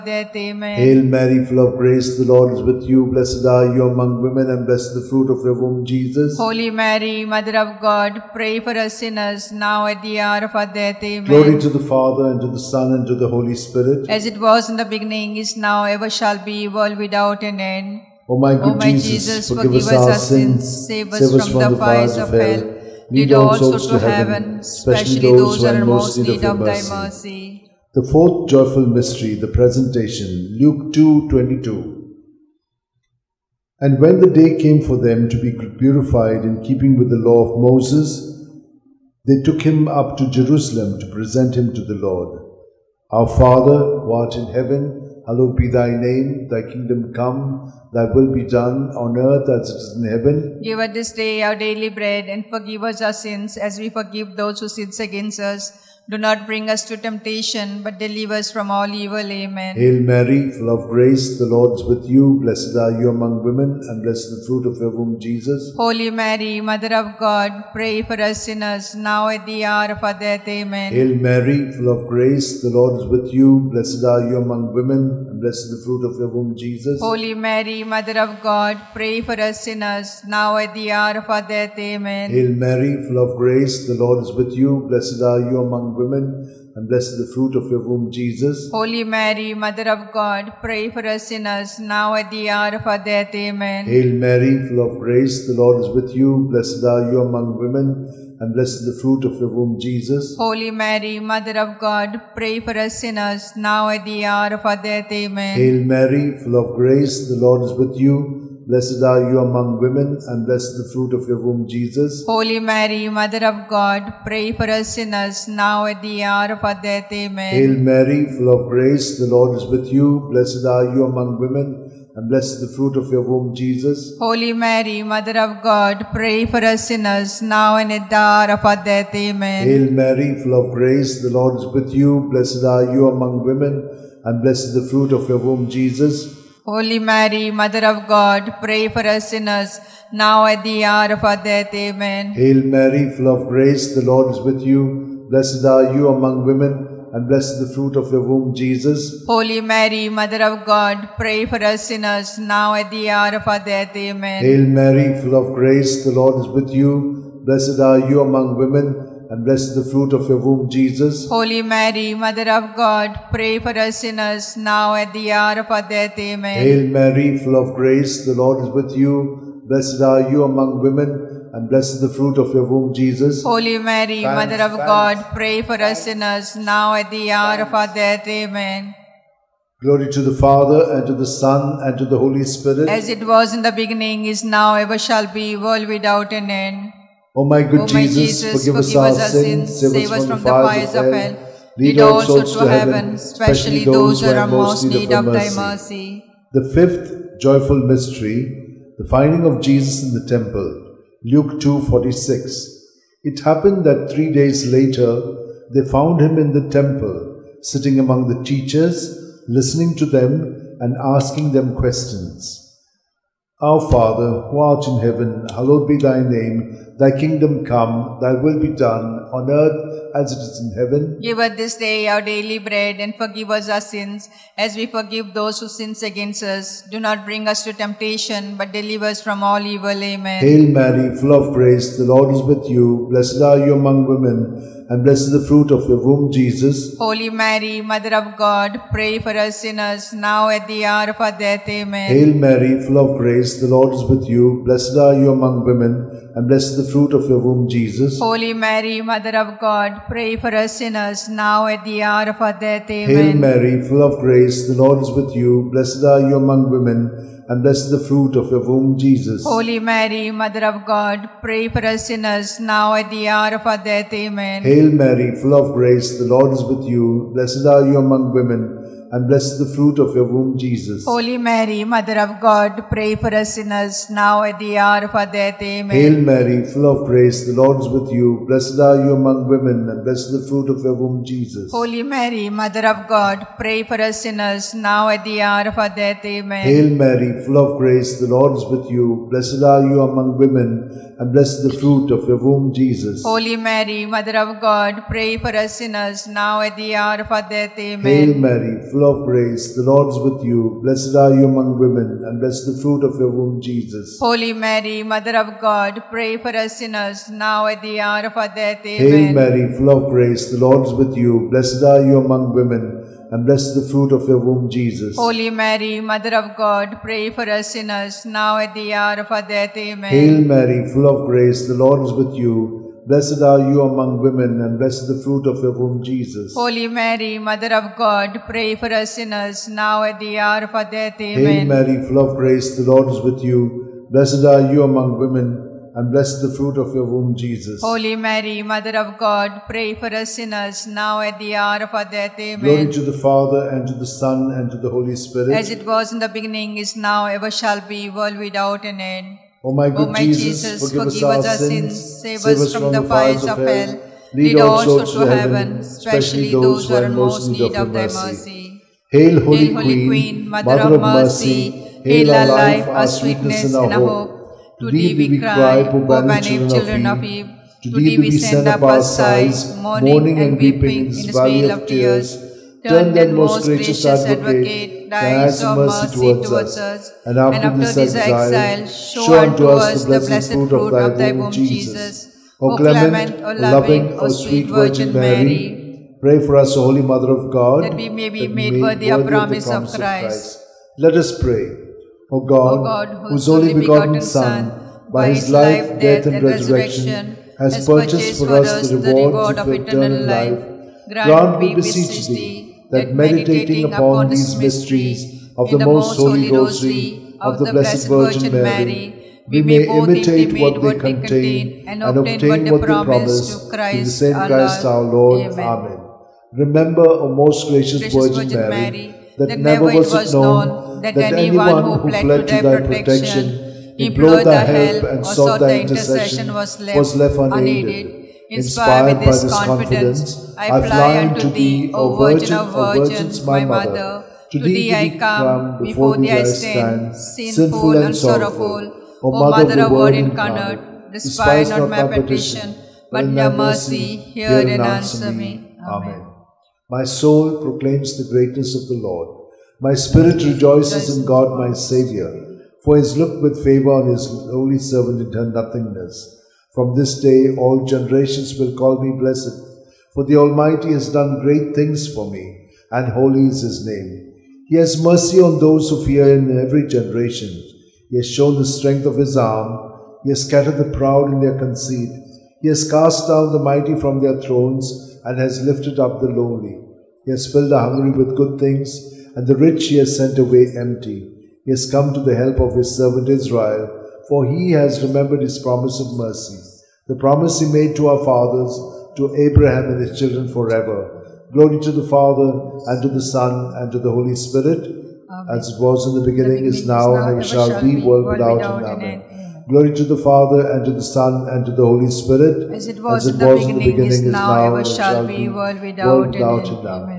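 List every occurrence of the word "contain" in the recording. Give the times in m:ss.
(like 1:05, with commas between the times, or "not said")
6:50.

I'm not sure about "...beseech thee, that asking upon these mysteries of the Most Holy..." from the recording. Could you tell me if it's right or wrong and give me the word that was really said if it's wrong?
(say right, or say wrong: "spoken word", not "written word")
wrong: "meditating", not "asking".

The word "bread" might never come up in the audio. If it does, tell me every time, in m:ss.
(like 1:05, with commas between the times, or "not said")
0:51, 3:42.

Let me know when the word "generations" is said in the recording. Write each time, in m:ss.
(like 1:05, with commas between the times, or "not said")
7:37, 7:46.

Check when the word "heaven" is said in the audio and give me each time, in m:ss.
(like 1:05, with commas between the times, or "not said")
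0:23, 0:44, 0:50, 3:12, 3:34, 3:40, 5:55.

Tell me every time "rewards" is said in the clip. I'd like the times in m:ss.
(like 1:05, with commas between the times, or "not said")
6:38.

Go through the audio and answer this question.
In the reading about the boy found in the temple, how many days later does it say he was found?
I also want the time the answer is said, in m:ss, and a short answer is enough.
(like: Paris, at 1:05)
3, at 3:24.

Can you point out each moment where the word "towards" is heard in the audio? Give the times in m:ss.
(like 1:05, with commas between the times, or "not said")
6:16.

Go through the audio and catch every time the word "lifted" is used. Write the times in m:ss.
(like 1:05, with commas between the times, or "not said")
7:55.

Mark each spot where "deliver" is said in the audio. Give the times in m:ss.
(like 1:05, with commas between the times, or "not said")
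0:57, 3:48.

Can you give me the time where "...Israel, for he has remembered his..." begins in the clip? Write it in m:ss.
8:03.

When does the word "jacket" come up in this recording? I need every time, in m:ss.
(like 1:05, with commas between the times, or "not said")
not said.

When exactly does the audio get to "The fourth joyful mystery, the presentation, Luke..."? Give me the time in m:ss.
0:27.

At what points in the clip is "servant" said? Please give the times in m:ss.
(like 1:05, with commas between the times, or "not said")
7:34, 8:02.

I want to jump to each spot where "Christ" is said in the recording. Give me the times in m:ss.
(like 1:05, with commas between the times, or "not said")
6:29, 6:54.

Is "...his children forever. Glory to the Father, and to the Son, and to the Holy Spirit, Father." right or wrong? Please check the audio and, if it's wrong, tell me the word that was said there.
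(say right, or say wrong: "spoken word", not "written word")
wrong: "Amen", not "Father".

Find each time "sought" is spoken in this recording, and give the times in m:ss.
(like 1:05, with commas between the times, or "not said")
7:05.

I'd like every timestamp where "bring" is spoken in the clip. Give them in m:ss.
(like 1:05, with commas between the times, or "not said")
0:56, 3:47.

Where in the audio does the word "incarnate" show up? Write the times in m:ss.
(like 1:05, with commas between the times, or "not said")
7:20.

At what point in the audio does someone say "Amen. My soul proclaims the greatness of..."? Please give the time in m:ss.
7:25.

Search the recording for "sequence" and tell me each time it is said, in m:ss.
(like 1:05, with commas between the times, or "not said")
not said.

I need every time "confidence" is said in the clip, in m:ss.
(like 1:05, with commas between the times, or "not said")
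7:09.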